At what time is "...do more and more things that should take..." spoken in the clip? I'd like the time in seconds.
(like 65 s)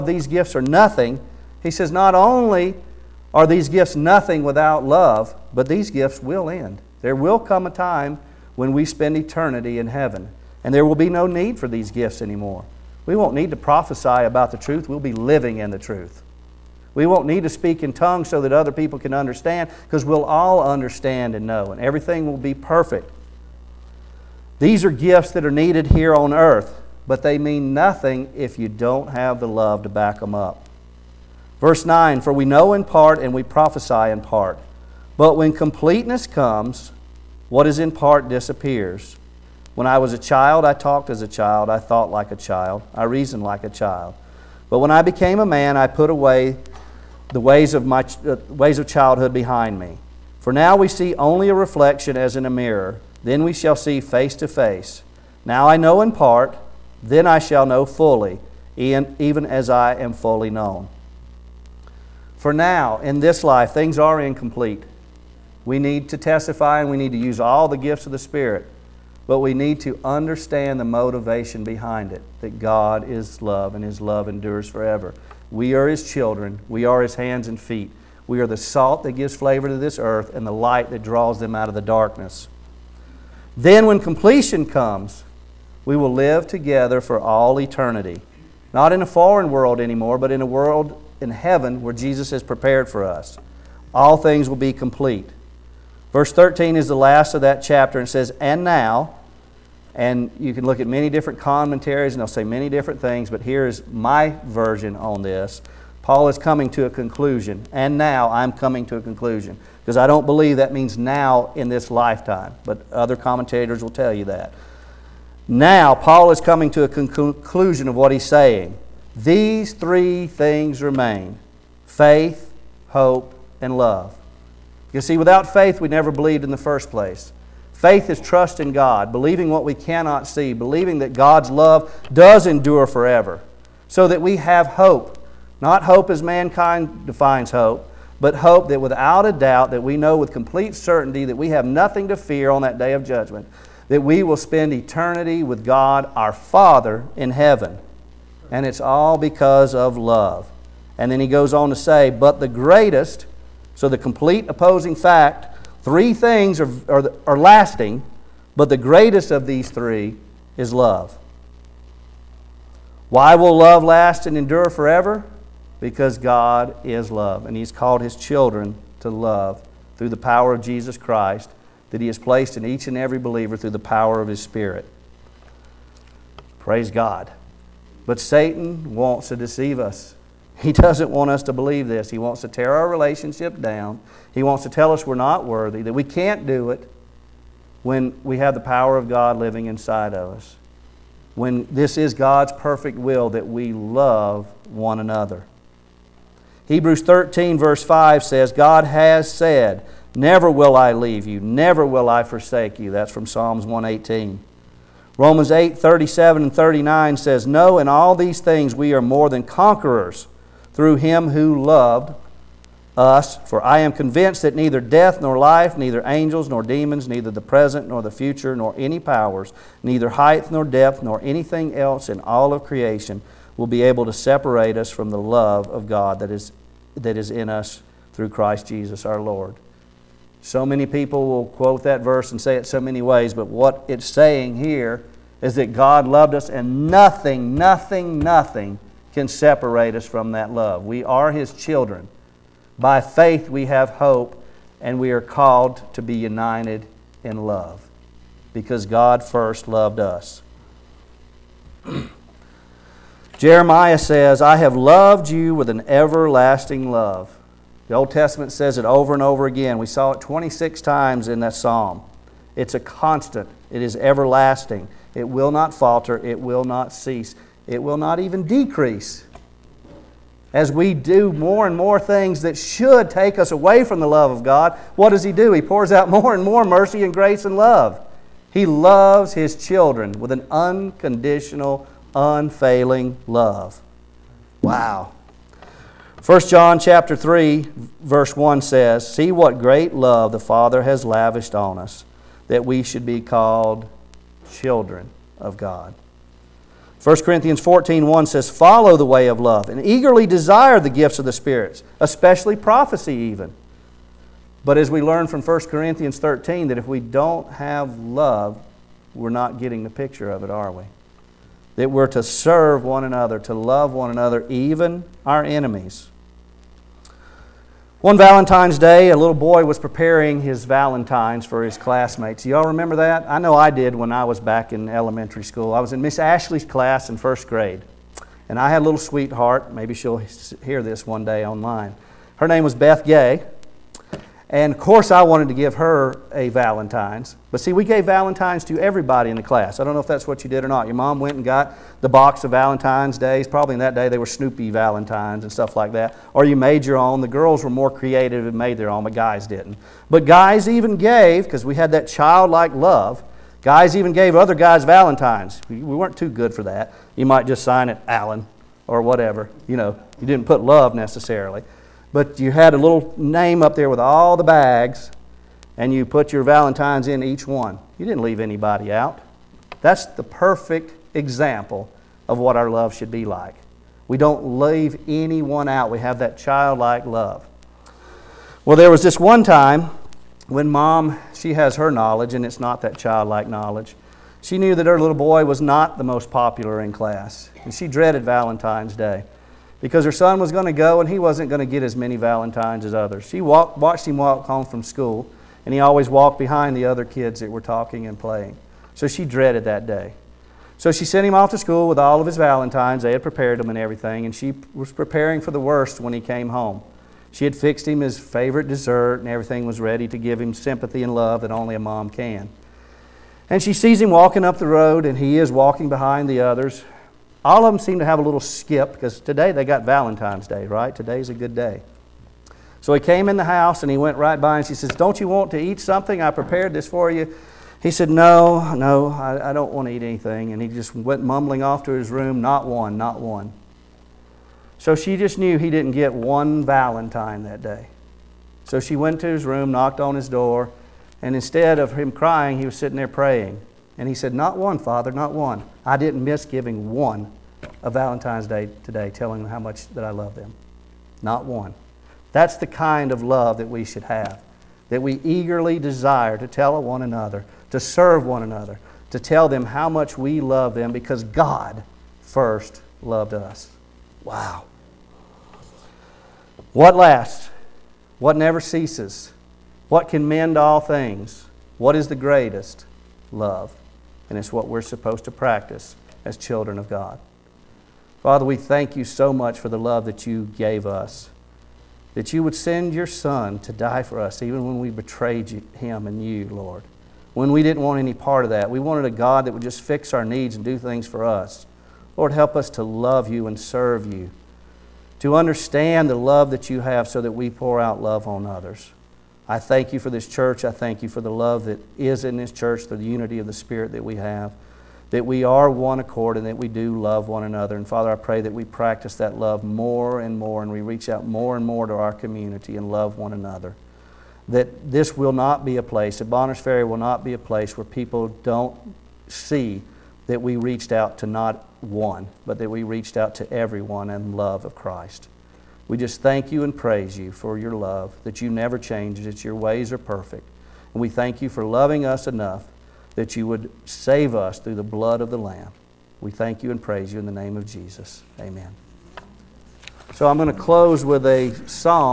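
270 s.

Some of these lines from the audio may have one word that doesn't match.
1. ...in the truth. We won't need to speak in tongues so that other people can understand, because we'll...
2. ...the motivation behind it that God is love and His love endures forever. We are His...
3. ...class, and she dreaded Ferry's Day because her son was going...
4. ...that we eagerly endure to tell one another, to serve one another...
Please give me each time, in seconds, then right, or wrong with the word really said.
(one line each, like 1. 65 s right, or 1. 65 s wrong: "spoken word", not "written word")
1. 15 s right
2. 70 s right
3. 386 s wrong: "Valentine", not "Ferry"
4. 454 s wrong: "desire", not "endure".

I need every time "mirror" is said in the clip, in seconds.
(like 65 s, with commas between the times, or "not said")
52 s.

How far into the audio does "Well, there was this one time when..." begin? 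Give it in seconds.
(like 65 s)
378 s.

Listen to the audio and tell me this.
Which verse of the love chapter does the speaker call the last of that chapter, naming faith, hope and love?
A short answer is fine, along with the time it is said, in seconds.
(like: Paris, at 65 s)
Verse 13, at 96 s.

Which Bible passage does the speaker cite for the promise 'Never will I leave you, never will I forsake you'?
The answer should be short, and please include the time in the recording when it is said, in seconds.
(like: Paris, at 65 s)
Psalms 118, at 203 s.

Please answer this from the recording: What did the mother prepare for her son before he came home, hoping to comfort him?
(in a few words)
His favorite dessert.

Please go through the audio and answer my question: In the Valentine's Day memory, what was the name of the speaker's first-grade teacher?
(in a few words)
Miss Ashley.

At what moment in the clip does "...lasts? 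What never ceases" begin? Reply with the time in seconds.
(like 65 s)
466 s.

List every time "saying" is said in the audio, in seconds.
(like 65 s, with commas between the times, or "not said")
118 s, 234 s.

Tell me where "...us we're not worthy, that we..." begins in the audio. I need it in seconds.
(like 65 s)
184 s.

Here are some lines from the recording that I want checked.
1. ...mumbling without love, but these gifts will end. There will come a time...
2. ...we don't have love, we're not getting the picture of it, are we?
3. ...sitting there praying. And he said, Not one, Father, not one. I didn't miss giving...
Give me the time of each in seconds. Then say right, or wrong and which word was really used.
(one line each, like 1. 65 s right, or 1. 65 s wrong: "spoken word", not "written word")
1. 3 s wrong: "nothing", not "mumbling"
2. 306 s right
3. 442 s right.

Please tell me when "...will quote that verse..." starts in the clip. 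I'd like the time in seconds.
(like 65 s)
231 s.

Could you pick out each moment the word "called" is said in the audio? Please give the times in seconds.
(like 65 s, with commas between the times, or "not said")
167 s, 245 s, 293 s.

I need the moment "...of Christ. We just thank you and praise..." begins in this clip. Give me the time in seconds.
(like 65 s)
524 s.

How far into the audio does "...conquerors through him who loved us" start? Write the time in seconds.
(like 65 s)
209 s.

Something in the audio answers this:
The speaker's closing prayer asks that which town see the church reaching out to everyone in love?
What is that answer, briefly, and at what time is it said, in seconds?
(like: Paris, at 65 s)
Bonners Ferry, at 516 s.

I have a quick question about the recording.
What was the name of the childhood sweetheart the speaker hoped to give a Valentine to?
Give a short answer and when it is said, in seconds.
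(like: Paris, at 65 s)
Beth Gay, at 332 s.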